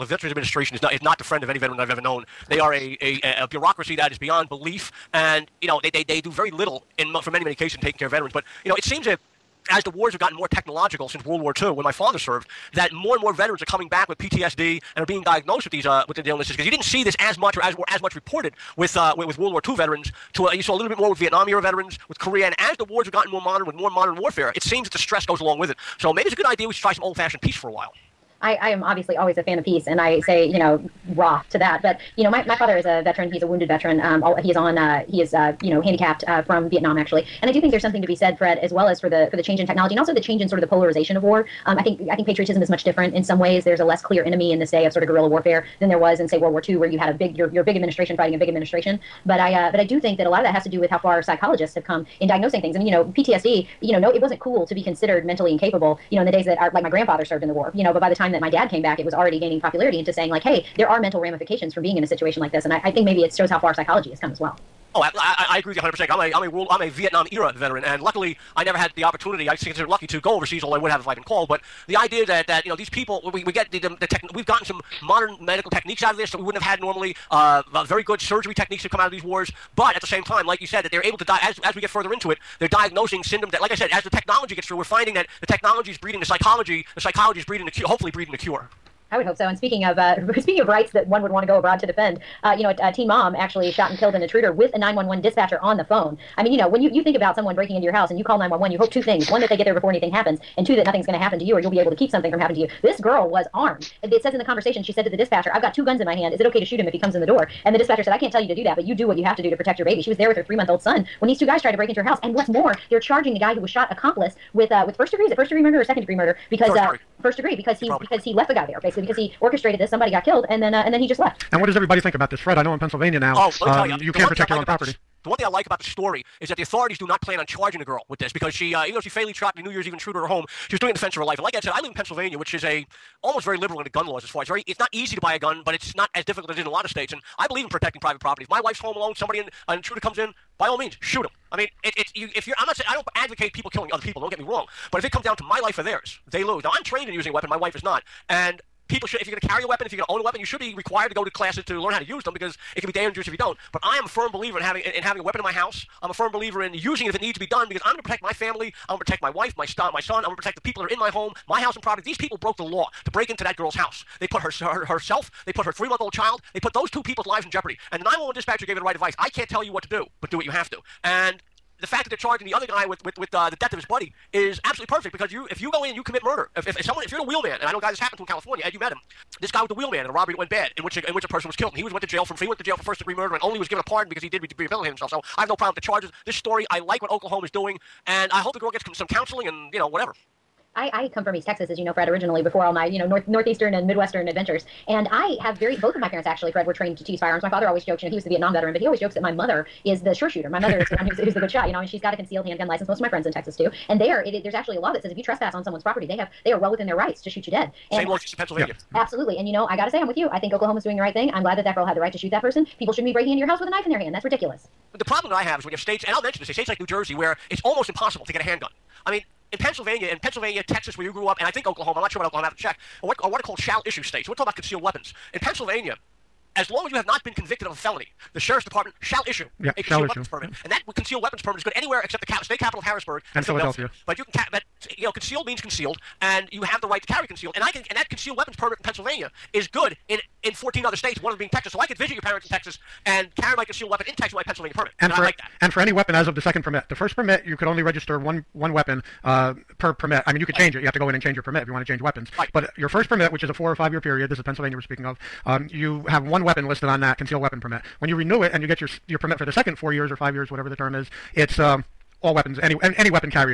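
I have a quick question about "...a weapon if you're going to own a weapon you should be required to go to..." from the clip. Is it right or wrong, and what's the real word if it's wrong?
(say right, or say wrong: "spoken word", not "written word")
right.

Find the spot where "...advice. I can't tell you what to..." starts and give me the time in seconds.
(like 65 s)
168 s.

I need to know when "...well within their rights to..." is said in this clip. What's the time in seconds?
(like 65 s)
206 s.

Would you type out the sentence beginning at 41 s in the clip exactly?
Um, I think I think patriotism is much different in some ways.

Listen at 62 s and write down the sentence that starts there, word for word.
And I, I think maybe it shows how far psychology has come as well.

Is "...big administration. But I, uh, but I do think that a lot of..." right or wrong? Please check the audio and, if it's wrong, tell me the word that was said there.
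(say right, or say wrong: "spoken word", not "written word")
right.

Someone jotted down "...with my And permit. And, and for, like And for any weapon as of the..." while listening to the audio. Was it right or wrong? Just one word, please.
wrong.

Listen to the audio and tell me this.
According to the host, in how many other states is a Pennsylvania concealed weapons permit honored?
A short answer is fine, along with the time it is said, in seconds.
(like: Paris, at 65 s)
14, at 240 s.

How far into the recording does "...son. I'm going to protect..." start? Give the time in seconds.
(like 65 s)
159 s.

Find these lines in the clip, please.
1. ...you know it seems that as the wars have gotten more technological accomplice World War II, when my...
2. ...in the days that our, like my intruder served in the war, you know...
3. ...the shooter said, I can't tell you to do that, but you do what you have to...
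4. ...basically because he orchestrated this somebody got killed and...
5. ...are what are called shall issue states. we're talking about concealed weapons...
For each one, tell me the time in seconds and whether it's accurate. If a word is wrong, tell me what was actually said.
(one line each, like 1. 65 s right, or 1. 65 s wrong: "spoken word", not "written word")
1. 8 s wrong: "since", not "accomplice"
2. 56 s wrong: "grandfather", not "intruder"
3. 107 s wrong: "dispatcher", not "shooter"
4. 118 s right
5. 223 s right.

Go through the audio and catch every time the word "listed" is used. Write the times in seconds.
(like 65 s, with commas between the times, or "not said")
256 s.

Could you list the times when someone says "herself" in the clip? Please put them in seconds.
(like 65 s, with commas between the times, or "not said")
164 s.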